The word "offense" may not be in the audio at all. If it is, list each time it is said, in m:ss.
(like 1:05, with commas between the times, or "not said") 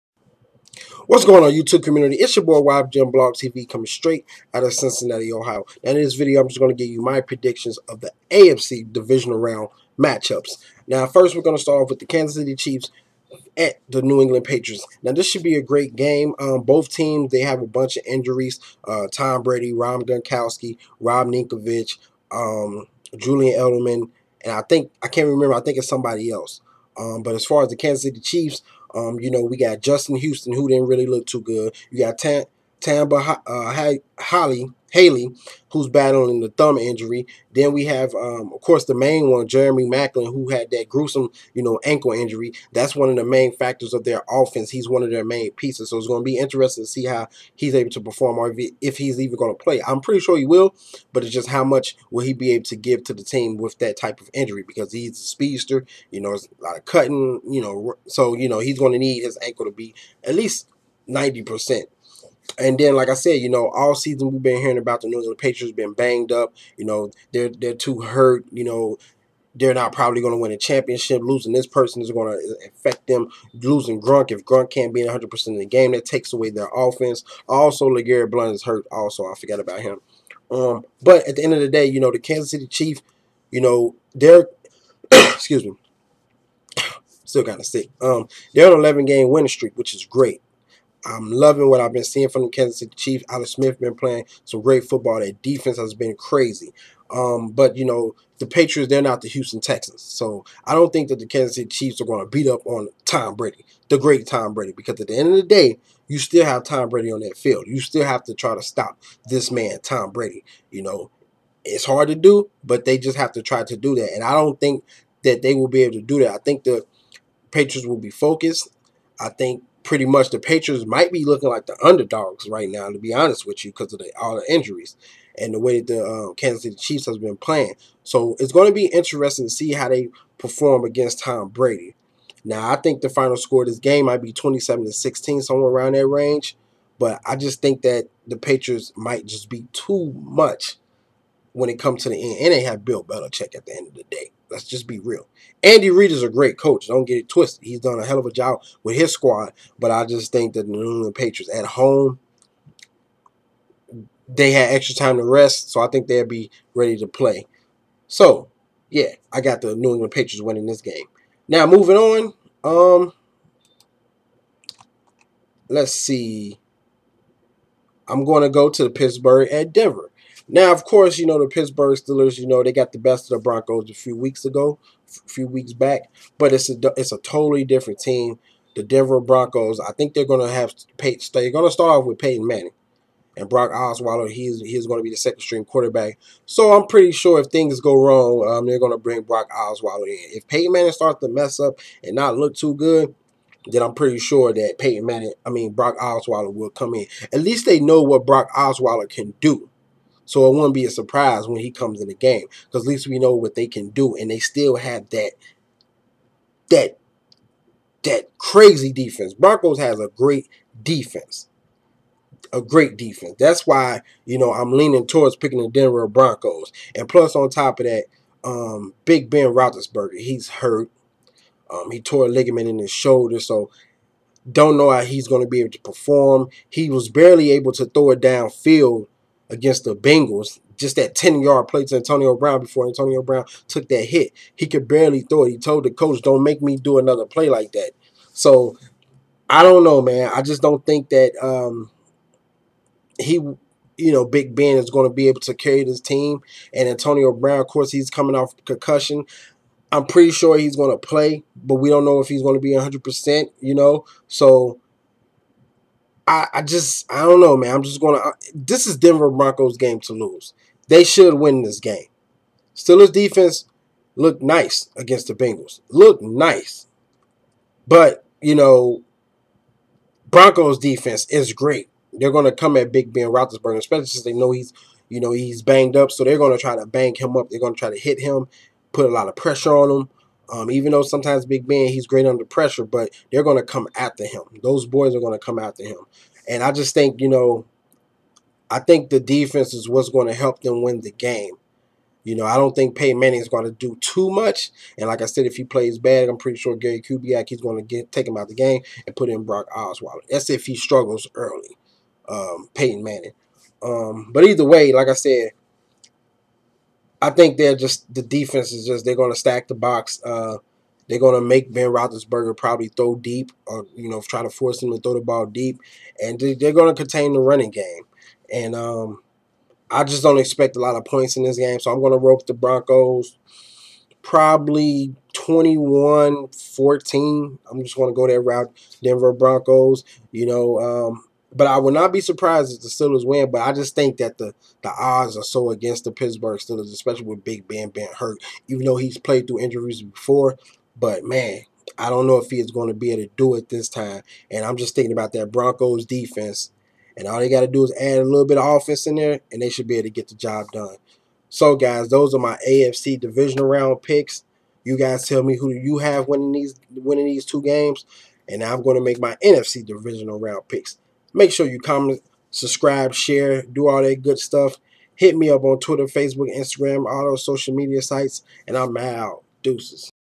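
0:44, 1:16, 5:48.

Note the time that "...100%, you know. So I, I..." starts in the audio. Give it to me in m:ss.
4:12.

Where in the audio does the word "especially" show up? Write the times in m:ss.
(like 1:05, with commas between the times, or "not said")
4:33, 5:36.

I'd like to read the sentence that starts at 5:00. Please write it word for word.
That's if he struggles early, um, Peyton Manning.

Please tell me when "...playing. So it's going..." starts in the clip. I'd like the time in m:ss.
2:07.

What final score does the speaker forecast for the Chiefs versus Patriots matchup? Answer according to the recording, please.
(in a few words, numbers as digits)
27 to 16.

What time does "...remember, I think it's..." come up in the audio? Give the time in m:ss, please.
0:25.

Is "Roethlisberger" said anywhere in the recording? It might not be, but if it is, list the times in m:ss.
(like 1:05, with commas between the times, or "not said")
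3:39, 4:33, 5:11.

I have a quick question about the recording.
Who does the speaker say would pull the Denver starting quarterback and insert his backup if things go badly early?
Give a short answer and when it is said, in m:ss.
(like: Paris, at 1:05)
Gary Kubiak, at 4:56.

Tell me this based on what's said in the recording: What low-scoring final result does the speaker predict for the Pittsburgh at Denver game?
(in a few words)
21-14.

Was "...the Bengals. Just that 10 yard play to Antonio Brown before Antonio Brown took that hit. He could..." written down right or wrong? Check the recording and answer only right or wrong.
right.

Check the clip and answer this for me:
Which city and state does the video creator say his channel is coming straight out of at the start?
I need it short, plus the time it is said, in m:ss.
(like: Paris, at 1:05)
Cincinnati, Ohio, at 0:04.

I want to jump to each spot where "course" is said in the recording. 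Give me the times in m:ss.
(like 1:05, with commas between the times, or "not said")
0:38, 2:50, 4:07.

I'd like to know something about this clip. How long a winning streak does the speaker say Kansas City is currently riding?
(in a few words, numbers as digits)
11 games.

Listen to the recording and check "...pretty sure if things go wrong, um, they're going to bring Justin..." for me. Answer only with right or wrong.
wrong.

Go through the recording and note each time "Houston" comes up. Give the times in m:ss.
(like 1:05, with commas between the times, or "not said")
0:30, 1:39.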